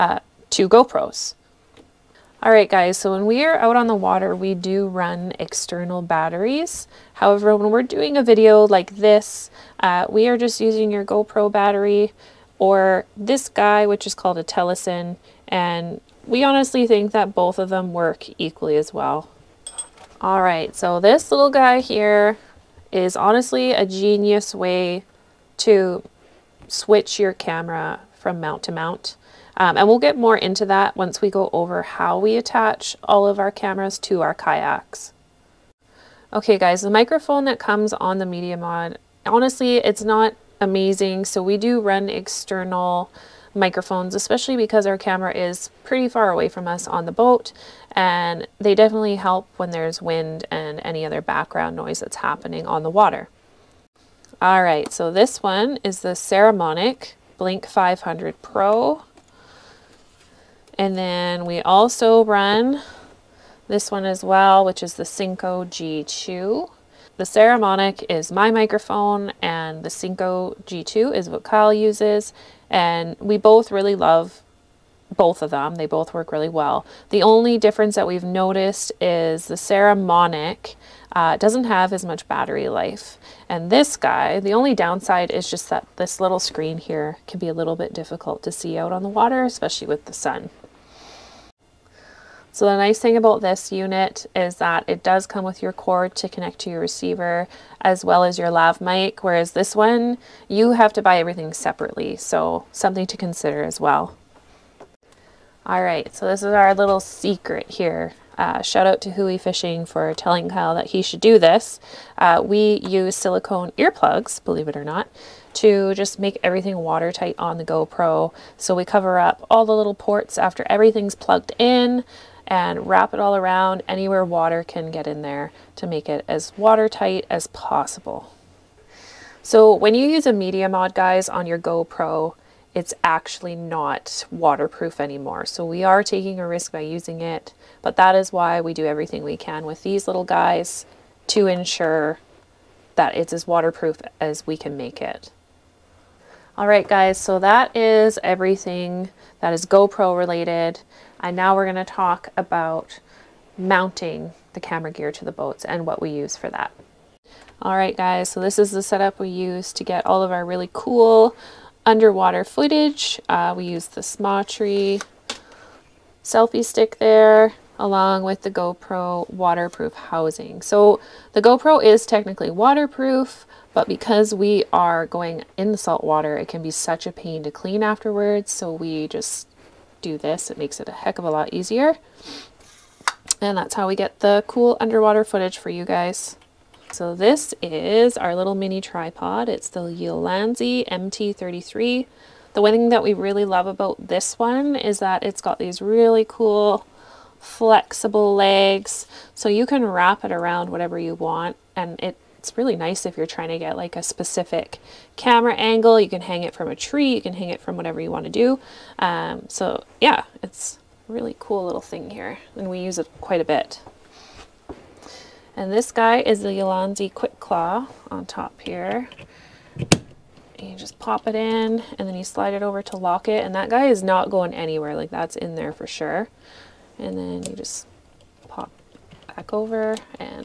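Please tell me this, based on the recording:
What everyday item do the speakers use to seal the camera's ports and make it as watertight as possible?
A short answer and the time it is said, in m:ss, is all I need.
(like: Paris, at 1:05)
silicone earplugs, at 1:53.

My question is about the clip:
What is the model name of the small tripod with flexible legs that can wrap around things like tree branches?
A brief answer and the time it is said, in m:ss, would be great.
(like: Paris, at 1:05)
Ulanzi MT33, at 3:09.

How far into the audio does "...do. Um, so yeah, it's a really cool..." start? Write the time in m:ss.
3:28.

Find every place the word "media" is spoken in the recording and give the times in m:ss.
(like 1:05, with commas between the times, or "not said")
0:38, 2:10.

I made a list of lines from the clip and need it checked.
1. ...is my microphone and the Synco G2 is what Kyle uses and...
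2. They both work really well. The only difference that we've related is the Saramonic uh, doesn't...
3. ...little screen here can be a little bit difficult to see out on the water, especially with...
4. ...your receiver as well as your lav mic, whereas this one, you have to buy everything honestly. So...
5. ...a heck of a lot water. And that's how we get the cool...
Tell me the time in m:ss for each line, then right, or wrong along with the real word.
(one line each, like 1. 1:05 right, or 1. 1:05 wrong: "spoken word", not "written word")
1. 1:08 right
2. 1:15 wrong: "noticed", not "related"
3. 1:26 right
4. 1:36 wrong: "separately", not "honestly"
5. 3:00 wrong: "easier", not "water".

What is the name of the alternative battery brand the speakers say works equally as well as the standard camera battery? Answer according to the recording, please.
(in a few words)
Telesin.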